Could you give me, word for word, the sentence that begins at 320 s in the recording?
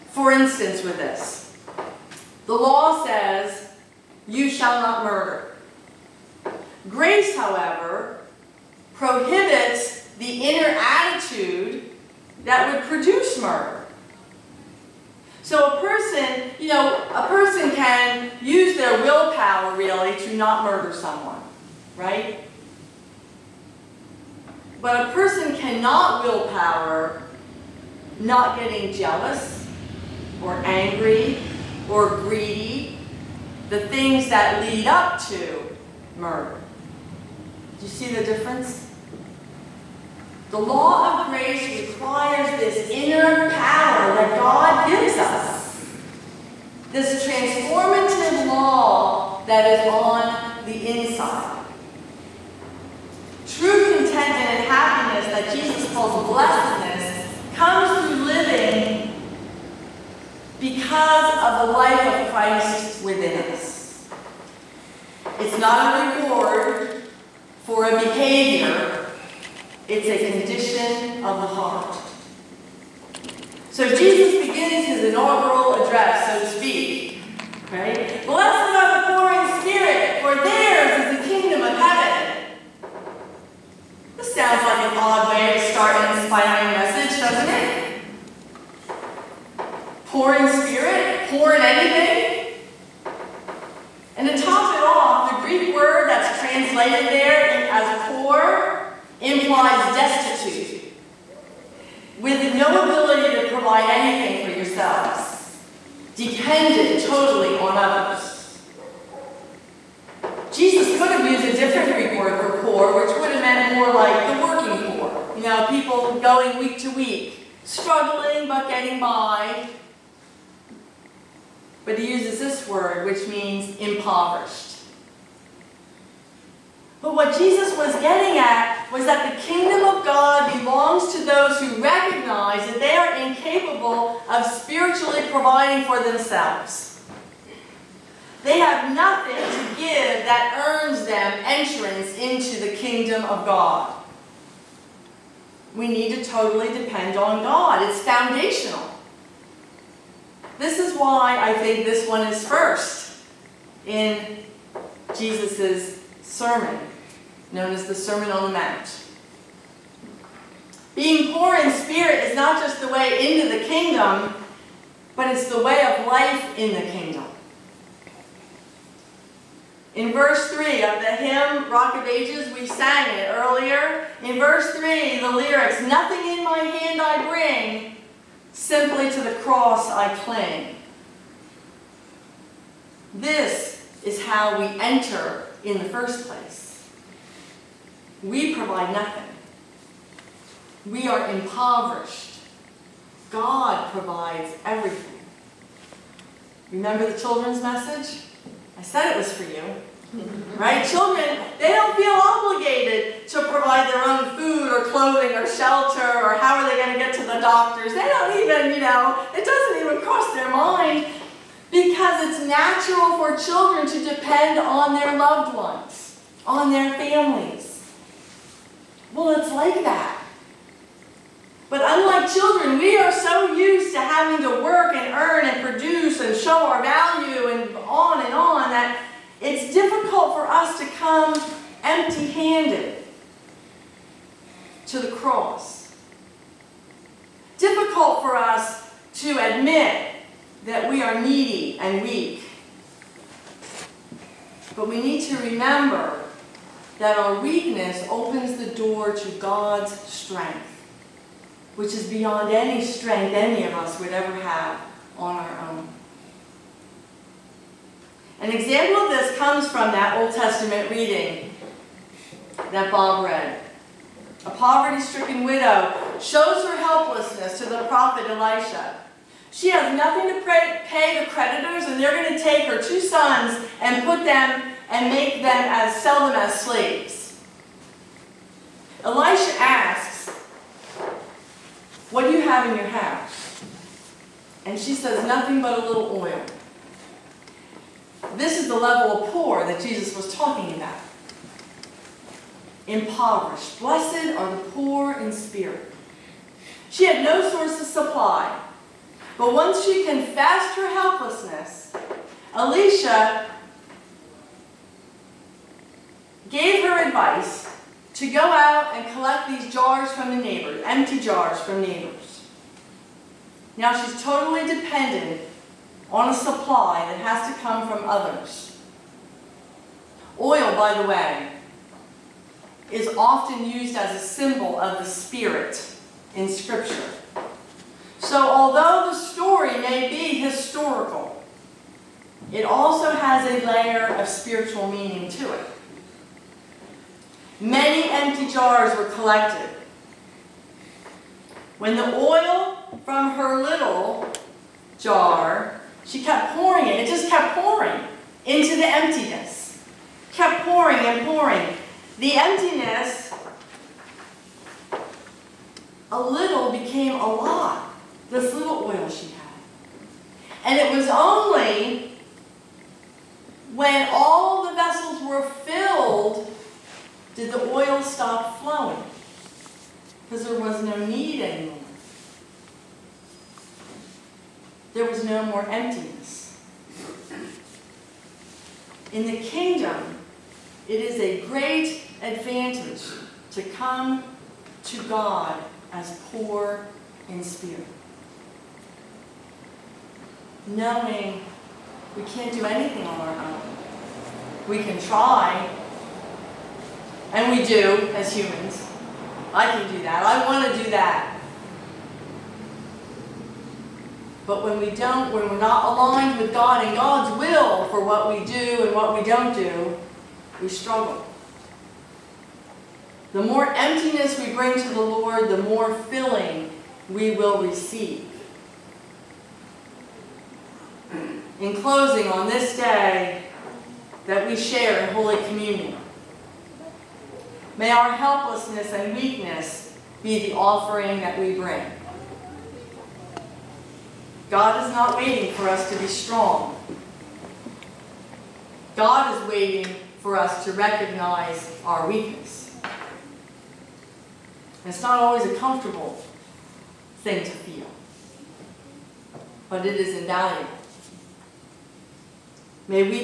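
Oil, by the way, is often used as a symbol of the Spirit in Scripture.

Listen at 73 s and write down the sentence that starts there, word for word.
So Jesus begins his inaugural address, so to speak, Right?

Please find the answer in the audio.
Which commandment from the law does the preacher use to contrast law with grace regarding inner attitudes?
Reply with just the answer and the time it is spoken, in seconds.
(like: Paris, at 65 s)
You shall not murder, at 4 s.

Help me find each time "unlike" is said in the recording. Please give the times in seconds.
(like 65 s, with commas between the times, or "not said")
221 s.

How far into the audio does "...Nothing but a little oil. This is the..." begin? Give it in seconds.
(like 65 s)
285 s.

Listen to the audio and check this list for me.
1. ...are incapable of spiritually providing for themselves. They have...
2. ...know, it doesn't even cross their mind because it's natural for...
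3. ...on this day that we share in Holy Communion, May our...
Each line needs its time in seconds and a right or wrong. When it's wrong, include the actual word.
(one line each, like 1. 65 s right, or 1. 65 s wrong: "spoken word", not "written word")
1. 132 s right
2. 208 s right
3. 422 s right.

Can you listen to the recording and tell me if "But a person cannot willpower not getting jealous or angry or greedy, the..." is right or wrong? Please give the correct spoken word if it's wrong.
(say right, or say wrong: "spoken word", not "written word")
right.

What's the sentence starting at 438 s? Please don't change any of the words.
God is waiting for us to recognize our weakness.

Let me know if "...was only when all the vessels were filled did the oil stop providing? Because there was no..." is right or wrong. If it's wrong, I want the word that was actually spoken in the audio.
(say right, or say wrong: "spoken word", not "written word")
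wrong: "flowing", not "providing".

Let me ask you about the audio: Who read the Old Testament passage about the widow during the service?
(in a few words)
Bob.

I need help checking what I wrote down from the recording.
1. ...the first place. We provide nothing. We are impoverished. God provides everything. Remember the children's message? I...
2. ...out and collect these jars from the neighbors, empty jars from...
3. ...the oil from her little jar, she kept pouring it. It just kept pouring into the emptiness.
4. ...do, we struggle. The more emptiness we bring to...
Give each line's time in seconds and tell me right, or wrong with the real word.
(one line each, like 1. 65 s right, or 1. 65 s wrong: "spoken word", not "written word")
1. 185 s right
2. 308 s right
3. 341 s right
4. 409 s right.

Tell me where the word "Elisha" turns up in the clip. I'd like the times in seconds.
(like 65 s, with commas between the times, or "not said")
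268 s, 279 s, 302 s.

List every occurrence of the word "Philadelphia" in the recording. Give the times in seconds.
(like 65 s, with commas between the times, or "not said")
not said.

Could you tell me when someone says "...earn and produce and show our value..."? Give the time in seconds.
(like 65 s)
225 s.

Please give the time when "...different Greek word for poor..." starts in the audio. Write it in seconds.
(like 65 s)
111 s.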